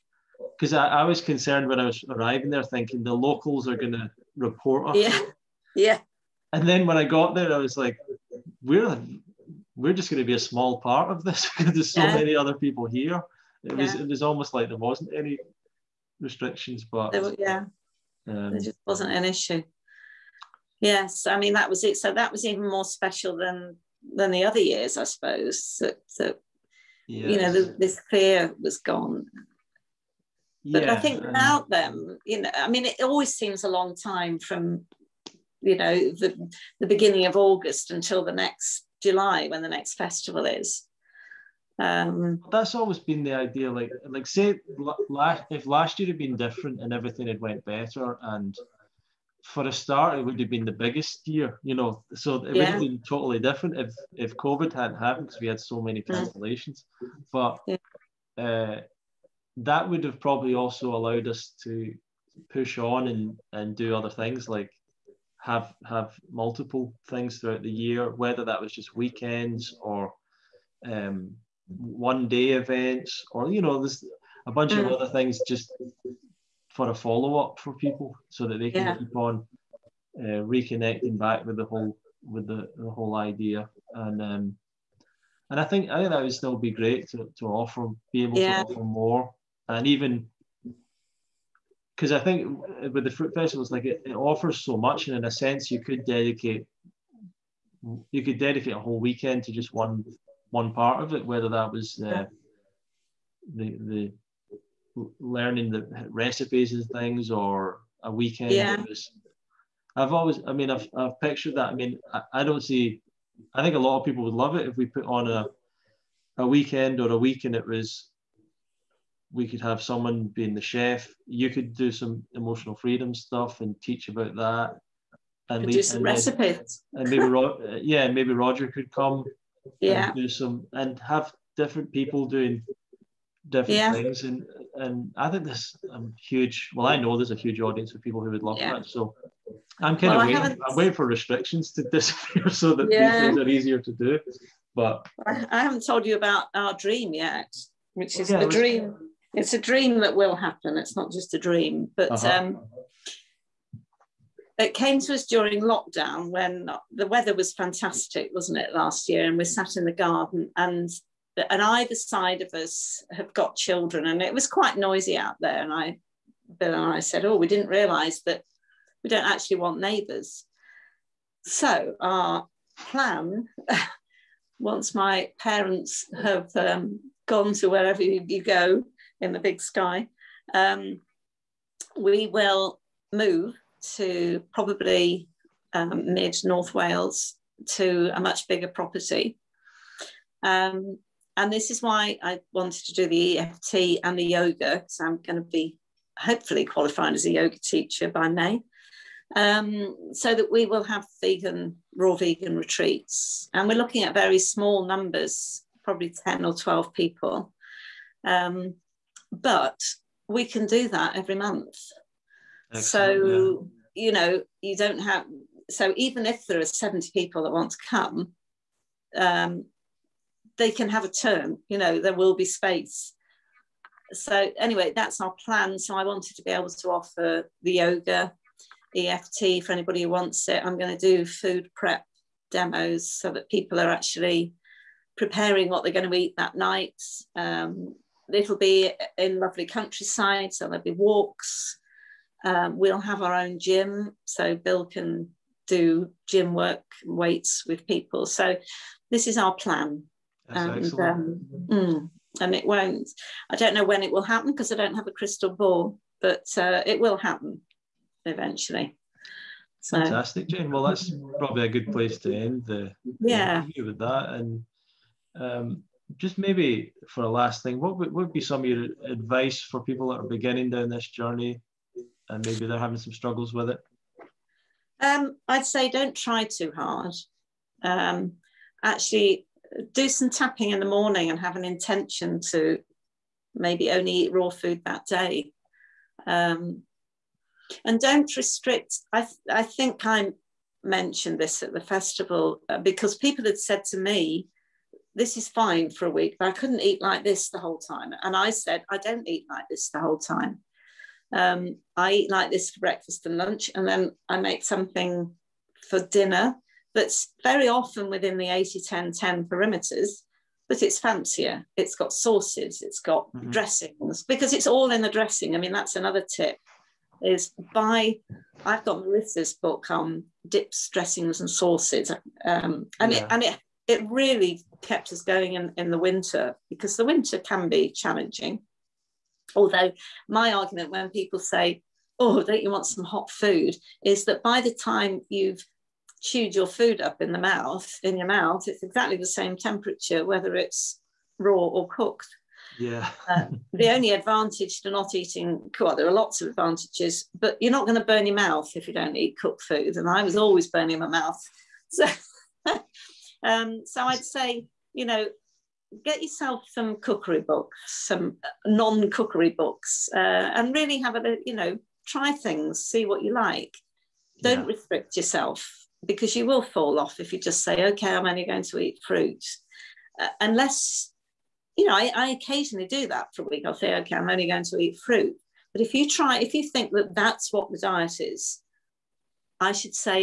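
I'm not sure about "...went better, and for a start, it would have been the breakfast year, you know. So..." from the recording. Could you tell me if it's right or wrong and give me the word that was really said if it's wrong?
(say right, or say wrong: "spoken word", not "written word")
wrong: "biggest", not "breakfast".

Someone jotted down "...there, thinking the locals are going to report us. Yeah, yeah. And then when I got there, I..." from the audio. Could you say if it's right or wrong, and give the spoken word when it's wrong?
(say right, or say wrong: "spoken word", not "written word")
right.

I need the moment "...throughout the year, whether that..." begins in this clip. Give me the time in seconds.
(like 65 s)
67 s.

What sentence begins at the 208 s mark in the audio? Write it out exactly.
Um, but we can do that every month.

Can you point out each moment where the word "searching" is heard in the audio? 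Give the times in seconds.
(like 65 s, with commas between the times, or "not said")
not said.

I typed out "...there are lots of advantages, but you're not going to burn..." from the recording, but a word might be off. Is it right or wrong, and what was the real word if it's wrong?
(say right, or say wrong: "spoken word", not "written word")
right.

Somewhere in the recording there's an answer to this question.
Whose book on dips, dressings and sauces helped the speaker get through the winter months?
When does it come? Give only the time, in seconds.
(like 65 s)
319 s.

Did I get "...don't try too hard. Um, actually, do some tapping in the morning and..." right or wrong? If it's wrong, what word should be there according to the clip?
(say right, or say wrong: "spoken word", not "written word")
right.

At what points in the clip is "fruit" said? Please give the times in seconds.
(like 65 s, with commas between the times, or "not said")
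93 s, 369 s, 374 s.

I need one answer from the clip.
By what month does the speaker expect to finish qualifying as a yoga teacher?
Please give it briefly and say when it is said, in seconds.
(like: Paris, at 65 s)
May, at 198 s.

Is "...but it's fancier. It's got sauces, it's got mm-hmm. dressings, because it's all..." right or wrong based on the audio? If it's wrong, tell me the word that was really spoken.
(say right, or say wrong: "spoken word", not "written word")
right.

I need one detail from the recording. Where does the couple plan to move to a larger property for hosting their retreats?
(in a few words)
mid North Wales.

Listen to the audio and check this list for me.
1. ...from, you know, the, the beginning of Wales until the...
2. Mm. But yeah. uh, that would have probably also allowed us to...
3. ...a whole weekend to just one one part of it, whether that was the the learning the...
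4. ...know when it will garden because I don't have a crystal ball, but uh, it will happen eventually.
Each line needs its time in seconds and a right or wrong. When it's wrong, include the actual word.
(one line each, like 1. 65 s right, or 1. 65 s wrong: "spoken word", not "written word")
1. 34 s wrong: "August", not "Wales"
2. 57 s right
3. 98 s right
4. 253 s wrong: "happen", not "garden".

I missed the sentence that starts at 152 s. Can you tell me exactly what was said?
um, it came to us during lockdown when the weather was fantastic, wasn't it, last year?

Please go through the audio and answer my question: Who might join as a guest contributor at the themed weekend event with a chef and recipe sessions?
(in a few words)
Roger.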